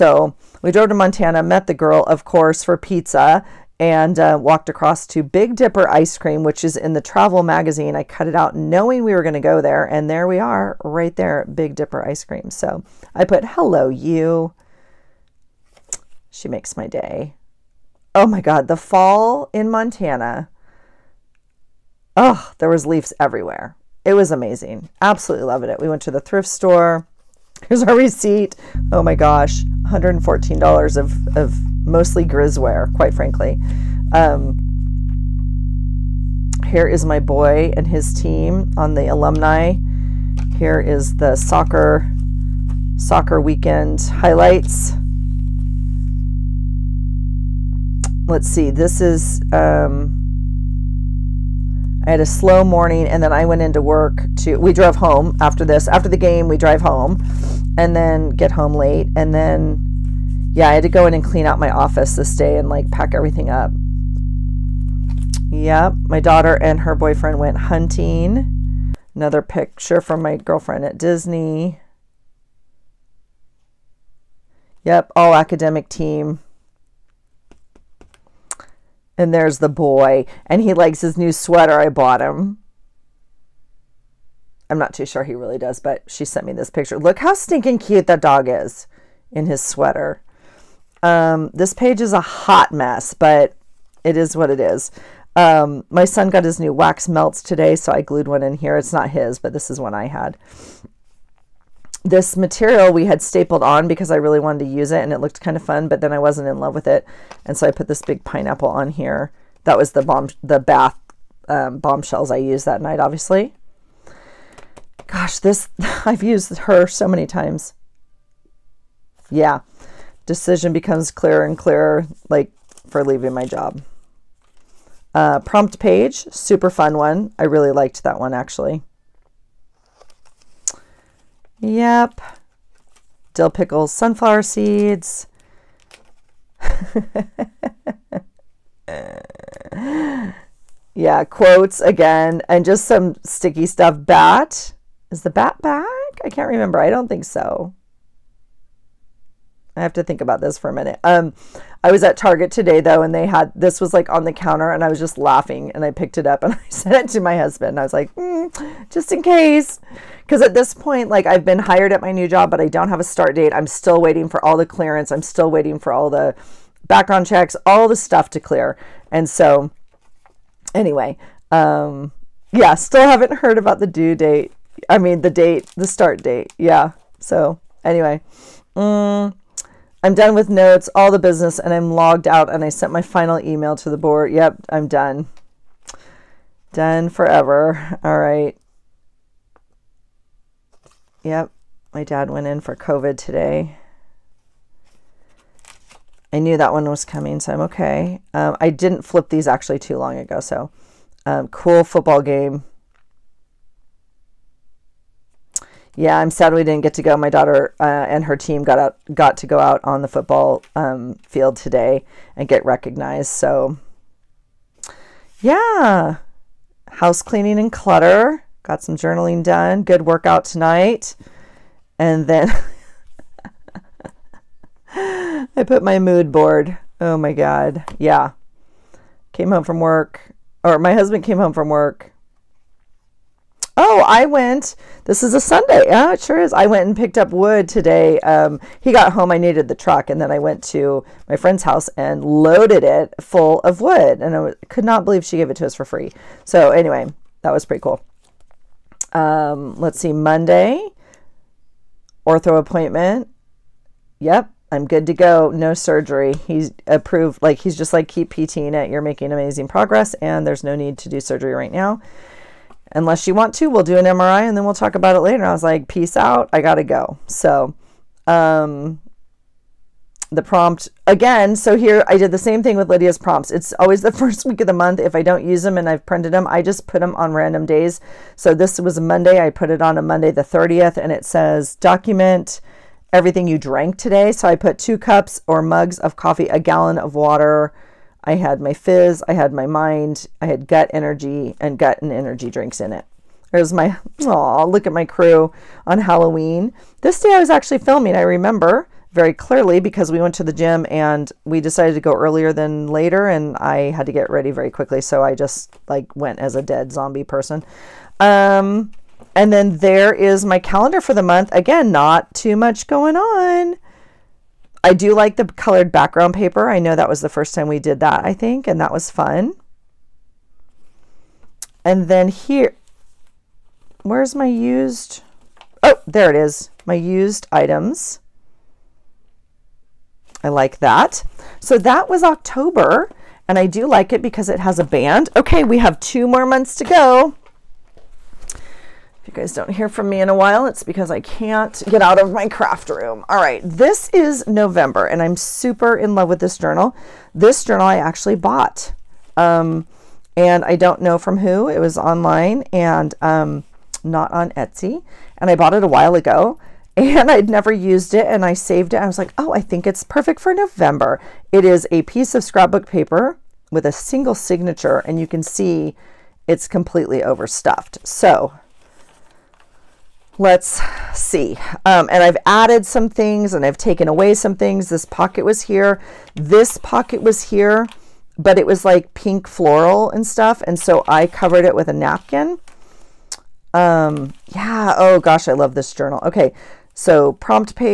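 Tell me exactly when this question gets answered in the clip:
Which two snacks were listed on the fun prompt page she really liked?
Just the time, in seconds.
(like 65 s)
133 s.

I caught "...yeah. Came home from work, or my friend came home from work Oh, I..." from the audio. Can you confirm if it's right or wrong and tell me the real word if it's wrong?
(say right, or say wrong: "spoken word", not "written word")
wrong: "husband", not "friend".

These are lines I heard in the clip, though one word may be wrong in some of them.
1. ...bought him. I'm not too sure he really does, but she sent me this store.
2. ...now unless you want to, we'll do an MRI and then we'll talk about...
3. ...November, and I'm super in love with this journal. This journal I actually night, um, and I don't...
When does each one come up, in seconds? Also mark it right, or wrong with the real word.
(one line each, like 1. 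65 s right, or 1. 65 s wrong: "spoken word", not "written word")
1. 81 s wrong: "picture", not "store"
2. 261 s right
3. 344 s wrong: "bought", not "night".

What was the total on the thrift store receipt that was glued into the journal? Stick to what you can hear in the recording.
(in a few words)
$114.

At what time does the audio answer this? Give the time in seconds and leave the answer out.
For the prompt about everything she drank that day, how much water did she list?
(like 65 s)
286 s.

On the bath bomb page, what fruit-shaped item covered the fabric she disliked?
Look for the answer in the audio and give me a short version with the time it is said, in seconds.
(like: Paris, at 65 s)
pineapple, at 108 s.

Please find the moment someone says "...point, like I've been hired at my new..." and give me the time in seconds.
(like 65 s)
160 s.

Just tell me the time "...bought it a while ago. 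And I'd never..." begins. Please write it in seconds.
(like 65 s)
355 s.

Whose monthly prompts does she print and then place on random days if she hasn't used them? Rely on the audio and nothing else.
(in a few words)
Lydia.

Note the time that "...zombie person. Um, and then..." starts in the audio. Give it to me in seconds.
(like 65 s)
306 s.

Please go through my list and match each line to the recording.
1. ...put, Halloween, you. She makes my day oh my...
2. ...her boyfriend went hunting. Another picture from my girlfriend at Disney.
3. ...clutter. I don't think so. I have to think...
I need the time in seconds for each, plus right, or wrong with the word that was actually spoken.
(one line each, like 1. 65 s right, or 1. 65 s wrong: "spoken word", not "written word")
1. 13 s wrong: "Hello", not "Halloween"
2. 66 s right
3. 146 s wrong: "remember", not "clutter".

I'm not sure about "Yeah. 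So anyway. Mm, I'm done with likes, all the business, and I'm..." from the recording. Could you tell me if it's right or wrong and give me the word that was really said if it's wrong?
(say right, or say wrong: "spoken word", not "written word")
wrong: "notes", not "likes".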